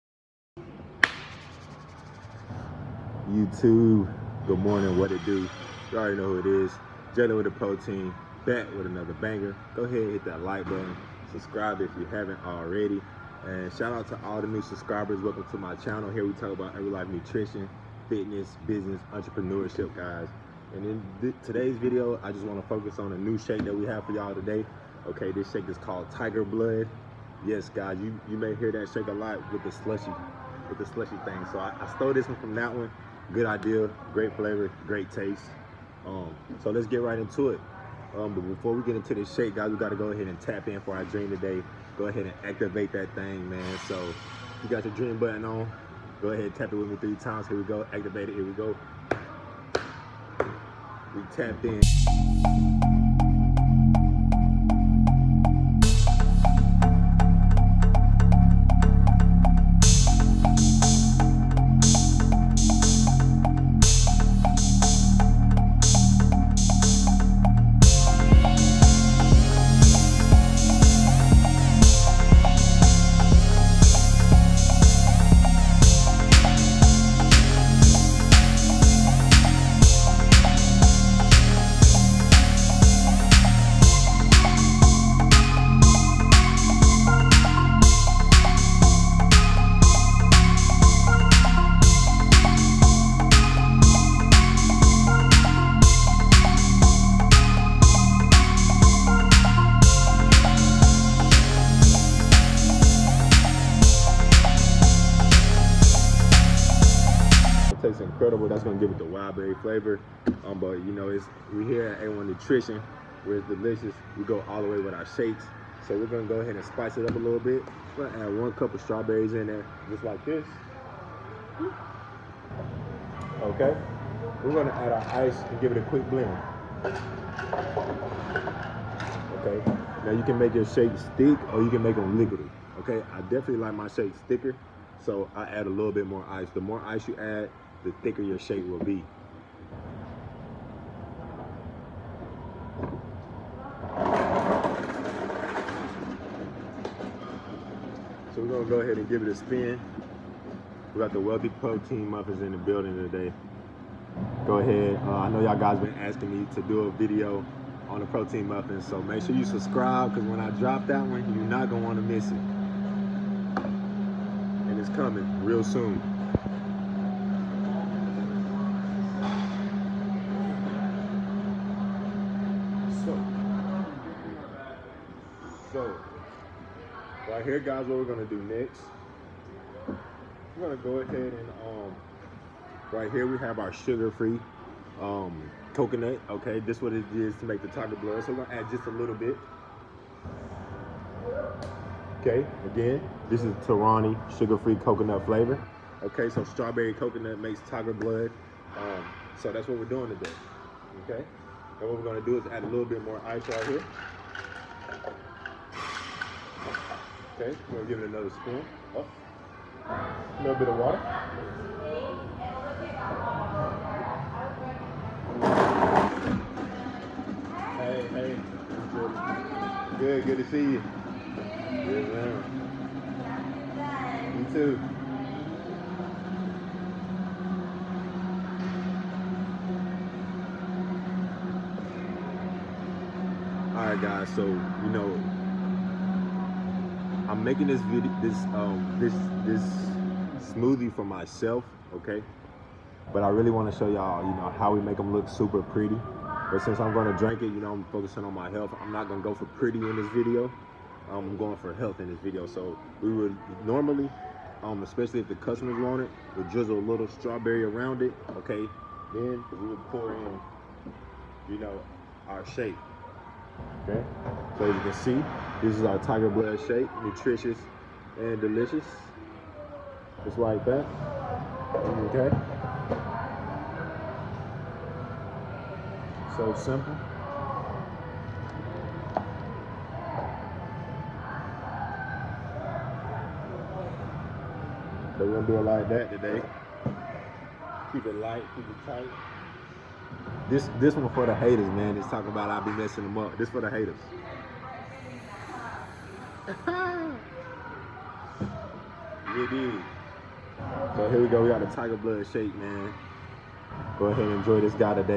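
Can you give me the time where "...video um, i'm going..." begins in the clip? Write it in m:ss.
4:10.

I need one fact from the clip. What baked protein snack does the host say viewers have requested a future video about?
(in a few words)
Wealthy Protein Muffins.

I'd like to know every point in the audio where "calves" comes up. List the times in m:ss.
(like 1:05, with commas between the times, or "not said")
not said.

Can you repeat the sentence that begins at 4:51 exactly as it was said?
It's talking about I be messing them up.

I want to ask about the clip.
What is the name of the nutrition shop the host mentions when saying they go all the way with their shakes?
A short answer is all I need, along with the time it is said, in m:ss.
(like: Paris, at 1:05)
A1 Nutrition, at 1:52.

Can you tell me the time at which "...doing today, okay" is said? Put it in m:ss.
3:19.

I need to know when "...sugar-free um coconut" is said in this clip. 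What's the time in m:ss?
3:03.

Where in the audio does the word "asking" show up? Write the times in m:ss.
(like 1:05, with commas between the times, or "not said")
2:35.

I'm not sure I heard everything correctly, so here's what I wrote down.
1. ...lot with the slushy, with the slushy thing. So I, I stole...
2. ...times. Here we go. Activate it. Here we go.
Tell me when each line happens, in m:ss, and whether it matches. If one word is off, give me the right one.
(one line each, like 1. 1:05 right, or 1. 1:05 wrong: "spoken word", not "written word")
1. 0:29 right
2. 0:47 right.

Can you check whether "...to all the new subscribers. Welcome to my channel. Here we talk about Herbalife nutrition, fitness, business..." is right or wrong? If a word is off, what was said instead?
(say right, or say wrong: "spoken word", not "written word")
right.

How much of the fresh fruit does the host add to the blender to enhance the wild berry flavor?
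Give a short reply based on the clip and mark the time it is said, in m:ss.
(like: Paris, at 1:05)
1 cup, at 1:58.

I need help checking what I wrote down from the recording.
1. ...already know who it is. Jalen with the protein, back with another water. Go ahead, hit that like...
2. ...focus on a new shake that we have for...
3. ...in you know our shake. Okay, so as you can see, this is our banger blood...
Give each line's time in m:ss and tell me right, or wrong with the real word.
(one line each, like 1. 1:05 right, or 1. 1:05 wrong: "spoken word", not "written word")
1. 0:05 wrong: "banger", not "water"
2. 0:22 right
3. 4:20 wrong: "tiger", not "banger".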